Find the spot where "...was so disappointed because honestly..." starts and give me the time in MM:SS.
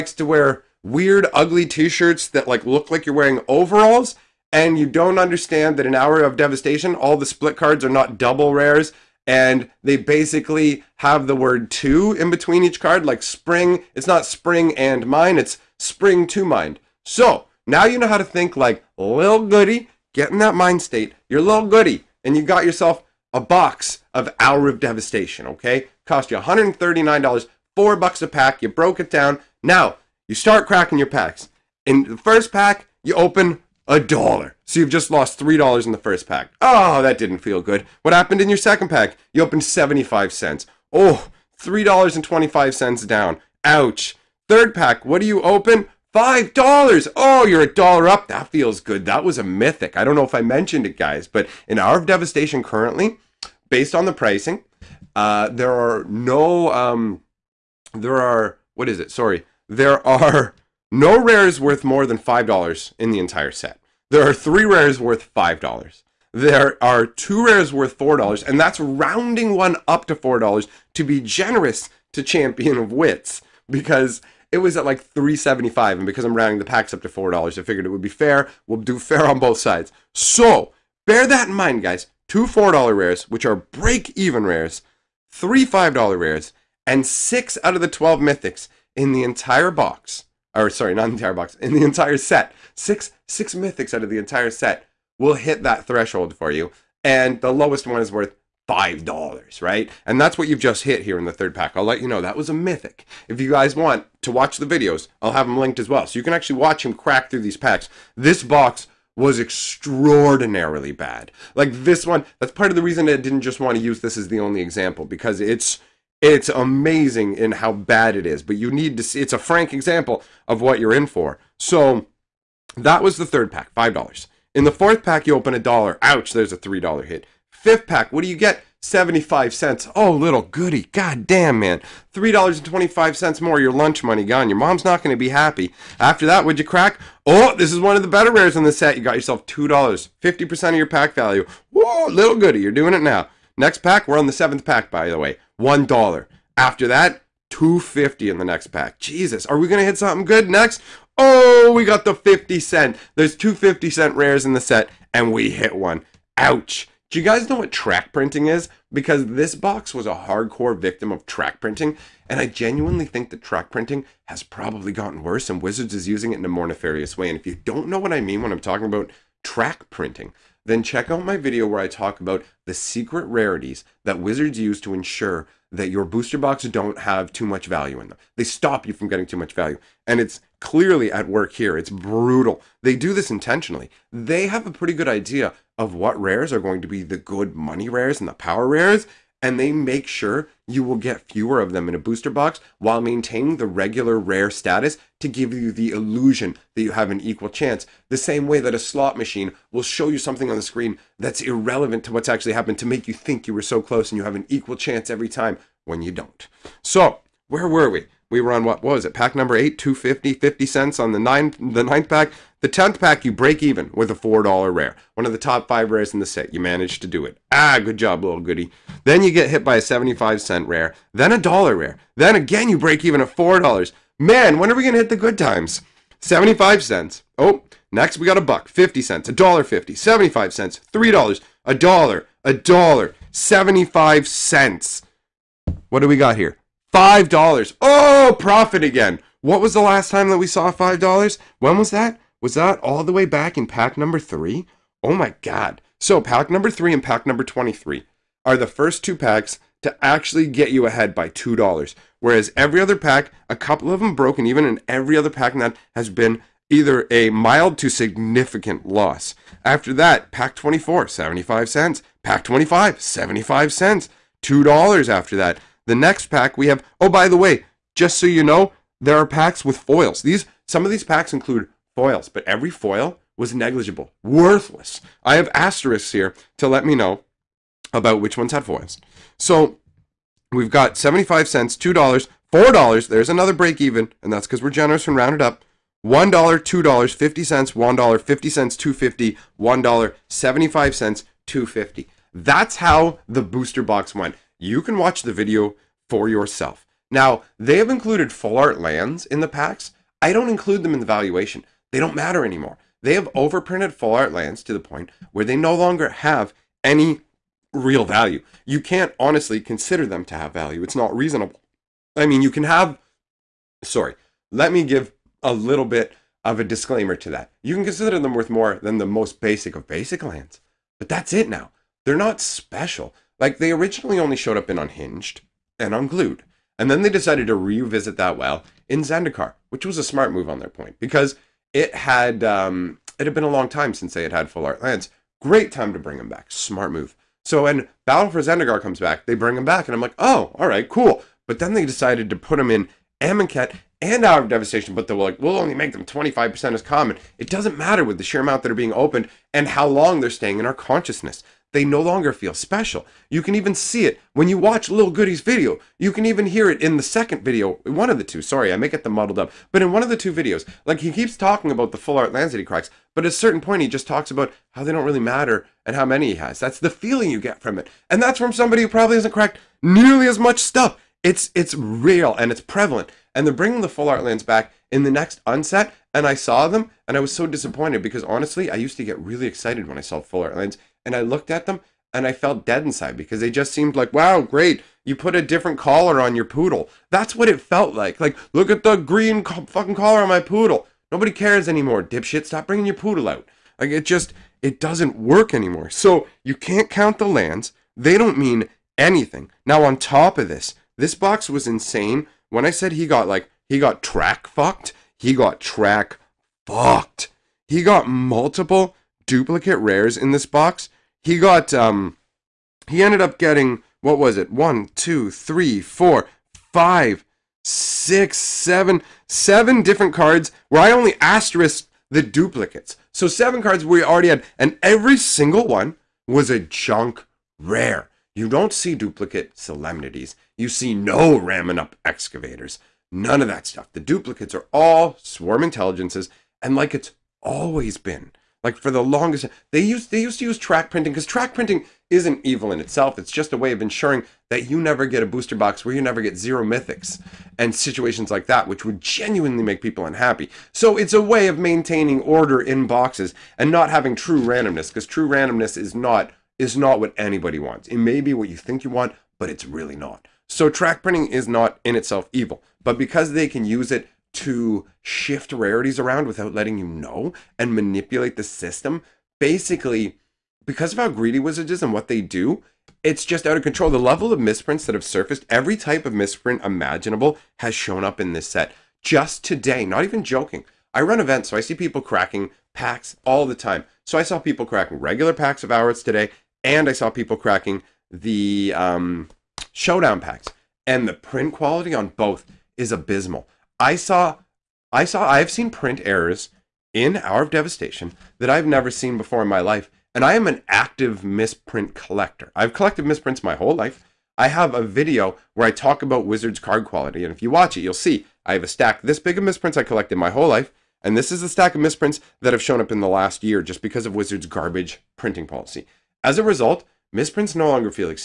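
06:17.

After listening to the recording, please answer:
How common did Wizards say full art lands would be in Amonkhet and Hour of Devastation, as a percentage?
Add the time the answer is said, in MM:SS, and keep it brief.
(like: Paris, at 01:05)
25%, at 05:46.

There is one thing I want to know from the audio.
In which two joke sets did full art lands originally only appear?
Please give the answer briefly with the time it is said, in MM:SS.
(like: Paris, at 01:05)
Unhinged and Unglued, at 05:24.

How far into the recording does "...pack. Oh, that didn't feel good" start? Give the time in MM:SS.
00:36.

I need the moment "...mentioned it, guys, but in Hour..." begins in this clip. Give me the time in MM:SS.
00:50.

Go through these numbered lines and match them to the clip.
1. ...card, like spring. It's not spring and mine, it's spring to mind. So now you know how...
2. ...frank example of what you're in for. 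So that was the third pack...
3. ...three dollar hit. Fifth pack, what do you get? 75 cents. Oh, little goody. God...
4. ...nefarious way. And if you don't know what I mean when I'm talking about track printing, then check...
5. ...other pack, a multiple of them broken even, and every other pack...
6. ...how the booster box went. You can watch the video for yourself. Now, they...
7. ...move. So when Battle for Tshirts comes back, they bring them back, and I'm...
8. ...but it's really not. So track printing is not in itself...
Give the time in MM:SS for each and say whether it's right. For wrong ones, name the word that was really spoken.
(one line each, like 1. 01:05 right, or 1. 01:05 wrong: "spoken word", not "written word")
1. 00:12 right
2. 01:59 right
3. 02:06 right
4. 02:46 right
5. 04:12 wrong: "couple", not "multiple"
6. 04:52 right
7. 05:36 wrong: "Zendikar", not "Tshirts"
8. 07:39 right.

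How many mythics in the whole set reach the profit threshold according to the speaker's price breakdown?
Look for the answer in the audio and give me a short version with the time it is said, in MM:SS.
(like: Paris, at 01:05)
6, at 01:33.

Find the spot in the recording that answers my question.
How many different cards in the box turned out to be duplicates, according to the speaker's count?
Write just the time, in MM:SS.
06:59.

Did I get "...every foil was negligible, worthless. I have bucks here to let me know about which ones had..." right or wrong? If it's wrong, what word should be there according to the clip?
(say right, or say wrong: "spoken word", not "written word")
wrong: "asterisks", not "bucks".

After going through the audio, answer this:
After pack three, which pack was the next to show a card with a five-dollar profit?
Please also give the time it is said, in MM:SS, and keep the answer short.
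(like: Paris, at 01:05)
23, at 04:07.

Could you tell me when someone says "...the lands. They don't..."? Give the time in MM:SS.
06:37.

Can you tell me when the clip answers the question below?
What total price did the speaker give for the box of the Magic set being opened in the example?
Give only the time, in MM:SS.
00:26.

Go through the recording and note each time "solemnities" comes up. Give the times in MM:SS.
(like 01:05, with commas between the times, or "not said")
07:09.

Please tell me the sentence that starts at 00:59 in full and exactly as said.
Sorry, there are no rare is worth more than $5 in the entire set.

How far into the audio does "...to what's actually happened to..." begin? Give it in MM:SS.
03:22.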